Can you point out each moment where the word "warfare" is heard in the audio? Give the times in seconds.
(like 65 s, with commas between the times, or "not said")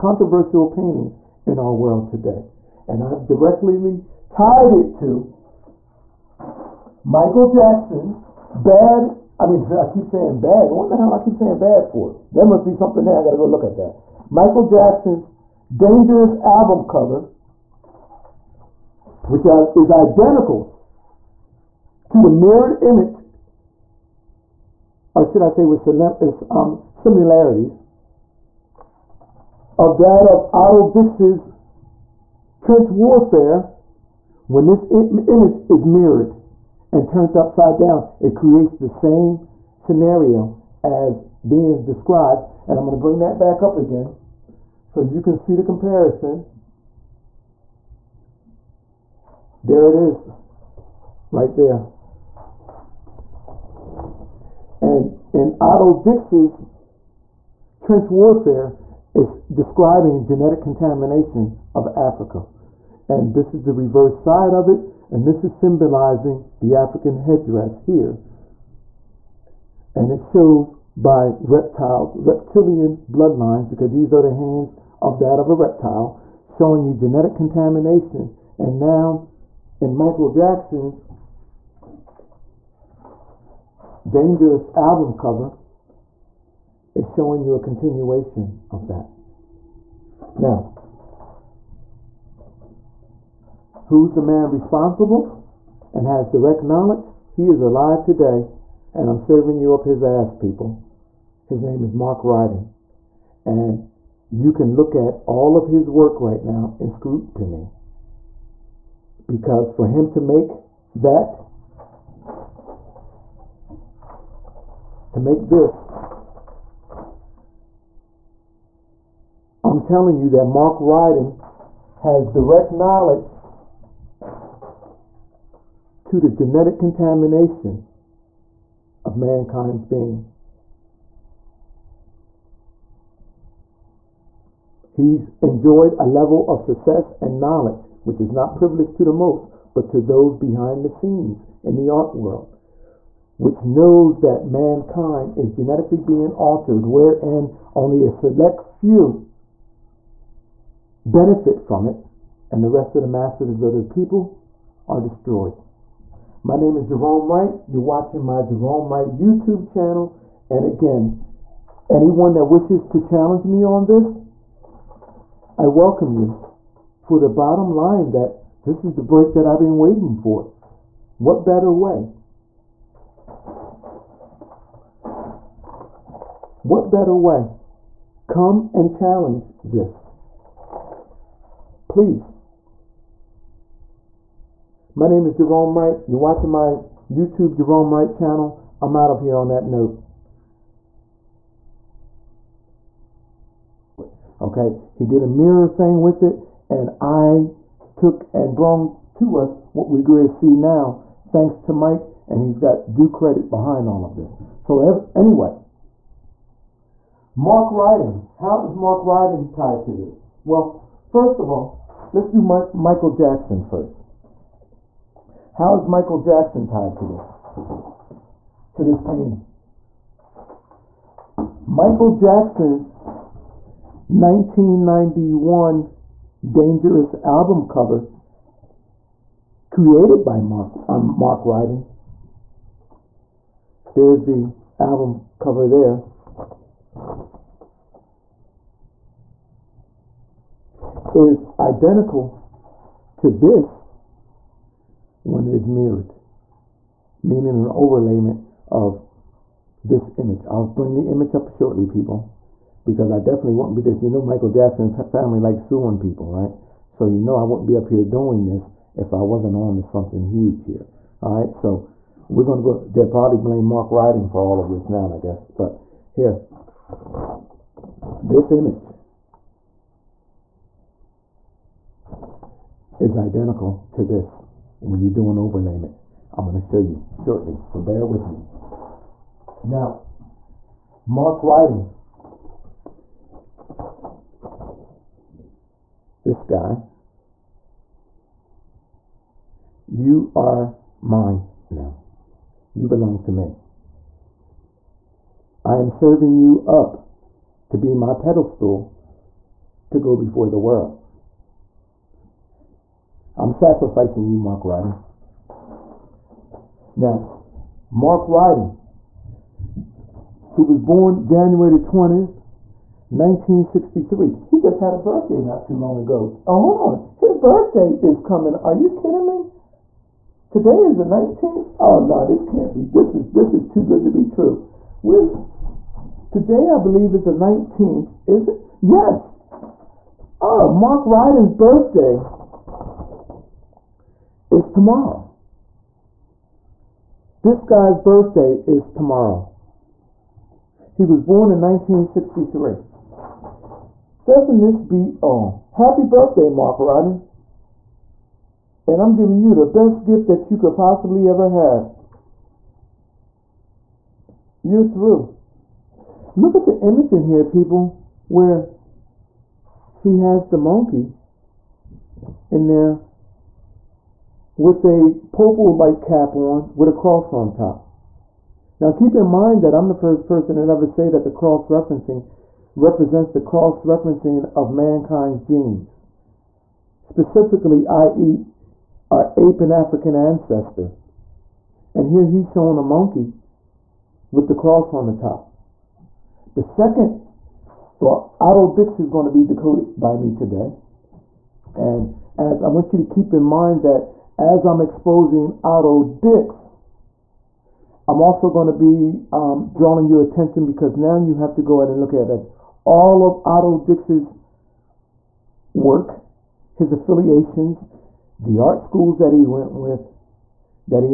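32 s, 58 s.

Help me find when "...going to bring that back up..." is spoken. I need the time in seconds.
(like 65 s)
42 s.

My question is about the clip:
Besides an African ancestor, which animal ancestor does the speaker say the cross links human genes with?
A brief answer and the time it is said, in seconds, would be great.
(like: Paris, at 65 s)
ape, at 379 s.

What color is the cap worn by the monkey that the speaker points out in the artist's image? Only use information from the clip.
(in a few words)
purple.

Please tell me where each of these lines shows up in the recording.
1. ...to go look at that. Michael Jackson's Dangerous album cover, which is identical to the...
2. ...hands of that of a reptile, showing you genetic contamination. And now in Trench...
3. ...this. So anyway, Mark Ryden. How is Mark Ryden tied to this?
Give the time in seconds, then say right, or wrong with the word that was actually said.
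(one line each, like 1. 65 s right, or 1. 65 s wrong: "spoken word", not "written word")
1. 13 s right
2. 74 s wrong: "Michael", not "Trench"
3. 204 s right.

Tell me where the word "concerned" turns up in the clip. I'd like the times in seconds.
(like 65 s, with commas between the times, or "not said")
not said.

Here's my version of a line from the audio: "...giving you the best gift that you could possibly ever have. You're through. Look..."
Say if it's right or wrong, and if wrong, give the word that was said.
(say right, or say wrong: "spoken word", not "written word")
right.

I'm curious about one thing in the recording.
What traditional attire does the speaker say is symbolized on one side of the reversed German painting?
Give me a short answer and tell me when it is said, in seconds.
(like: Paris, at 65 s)
African headdress, at 66 s.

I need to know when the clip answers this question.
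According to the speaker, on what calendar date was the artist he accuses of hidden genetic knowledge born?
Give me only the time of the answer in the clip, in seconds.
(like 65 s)
311 s.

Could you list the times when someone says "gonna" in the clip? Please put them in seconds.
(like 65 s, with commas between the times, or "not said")
262 s.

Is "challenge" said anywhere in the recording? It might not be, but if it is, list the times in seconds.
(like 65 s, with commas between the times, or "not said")
163 s, 178 s.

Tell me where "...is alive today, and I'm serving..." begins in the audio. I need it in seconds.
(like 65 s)
97 s.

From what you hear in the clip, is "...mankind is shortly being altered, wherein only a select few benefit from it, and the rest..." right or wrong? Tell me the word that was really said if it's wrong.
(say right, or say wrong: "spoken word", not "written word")
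wrong: "genetically", not "shortly".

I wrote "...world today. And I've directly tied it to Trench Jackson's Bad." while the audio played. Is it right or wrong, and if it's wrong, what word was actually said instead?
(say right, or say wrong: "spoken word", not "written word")
wrong: "Michael", not "Trench".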